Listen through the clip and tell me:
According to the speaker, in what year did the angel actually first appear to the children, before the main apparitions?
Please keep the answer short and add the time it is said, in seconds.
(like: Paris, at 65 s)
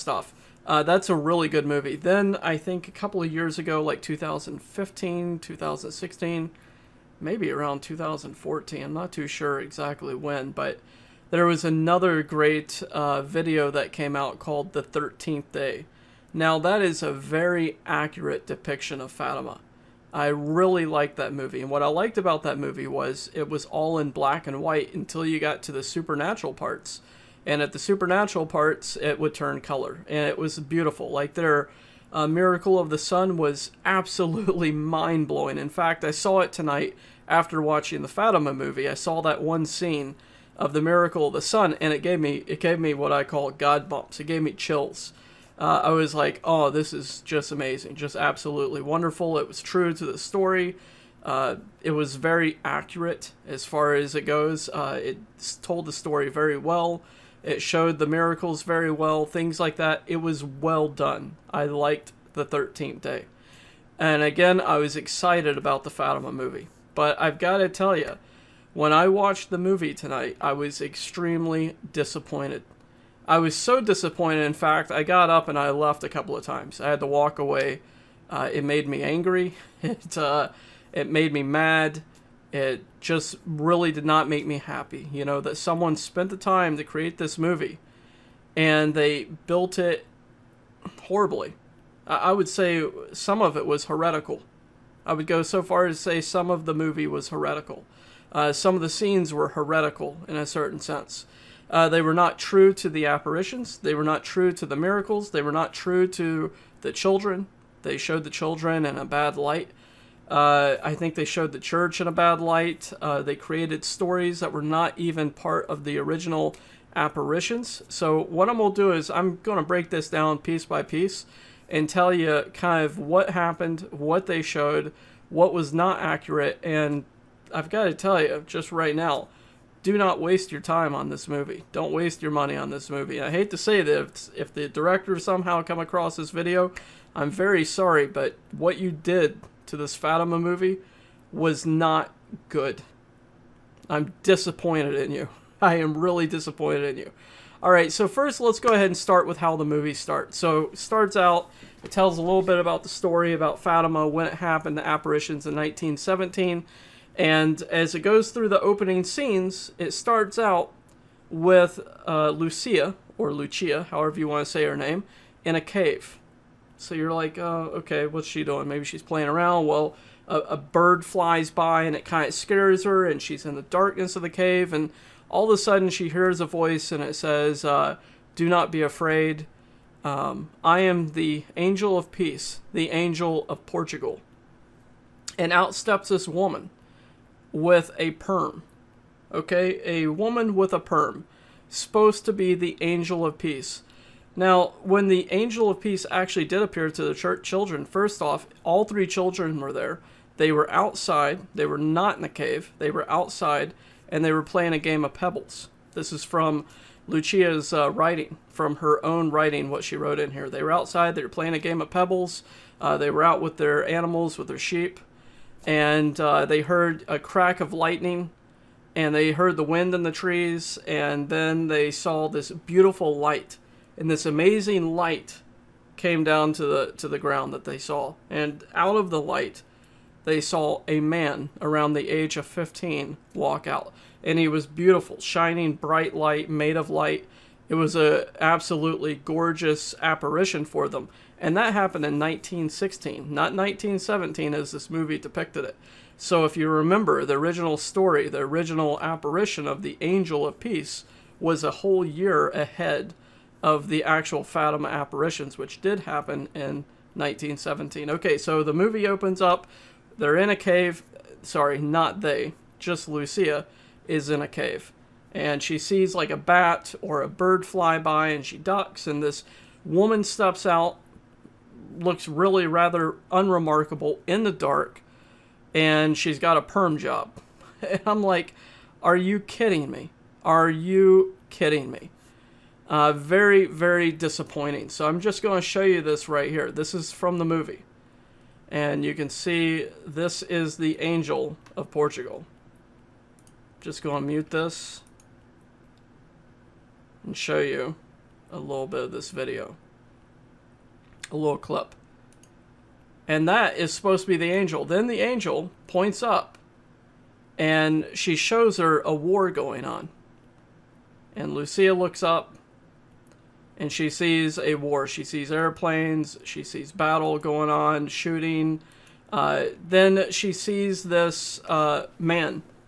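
1916, at 242 s.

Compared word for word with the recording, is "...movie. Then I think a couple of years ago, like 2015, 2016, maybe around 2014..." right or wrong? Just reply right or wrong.
right.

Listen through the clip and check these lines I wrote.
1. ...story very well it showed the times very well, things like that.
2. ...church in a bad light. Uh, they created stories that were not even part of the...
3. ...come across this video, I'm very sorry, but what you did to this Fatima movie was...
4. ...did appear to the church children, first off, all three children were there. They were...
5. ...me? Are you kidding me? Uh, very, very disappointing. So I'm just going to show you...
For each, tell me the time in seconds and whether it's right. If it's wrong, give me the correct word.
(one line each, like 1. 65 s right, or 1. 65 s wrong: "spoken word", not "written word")
1. 55 s wrong: "miracles", not "times"
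2. 111 s right
3. 135 s right
4. 196 s right
5. 279 s right.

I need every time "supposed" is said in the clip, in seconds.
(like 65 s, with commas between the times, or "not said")
191 s, 303 s.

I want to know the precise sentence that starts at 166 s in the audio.
So you're like, oh, okay, what's she doing?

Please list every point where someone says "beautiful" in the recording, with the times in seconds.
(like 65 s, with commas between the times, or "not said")
30 s, 222 s, 234 s.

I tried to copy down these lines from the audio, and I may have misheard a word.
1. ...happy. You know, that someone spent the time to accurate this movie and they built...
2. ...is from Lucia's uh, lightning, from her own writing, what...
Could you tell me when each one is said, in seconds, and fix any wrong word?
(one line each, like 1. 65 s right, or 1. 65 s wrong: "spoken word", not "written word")
1. 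84 s wrong: "create", not "accurate"
2. 206 s wrong: "writing", not "lightning".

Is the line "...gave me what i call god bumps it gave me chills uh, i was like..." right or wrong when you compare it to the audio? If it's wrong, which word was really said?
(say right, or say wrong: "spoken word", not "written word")
right.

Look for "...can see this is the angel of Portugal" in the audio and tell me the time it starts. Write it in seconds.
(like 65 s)
289 s.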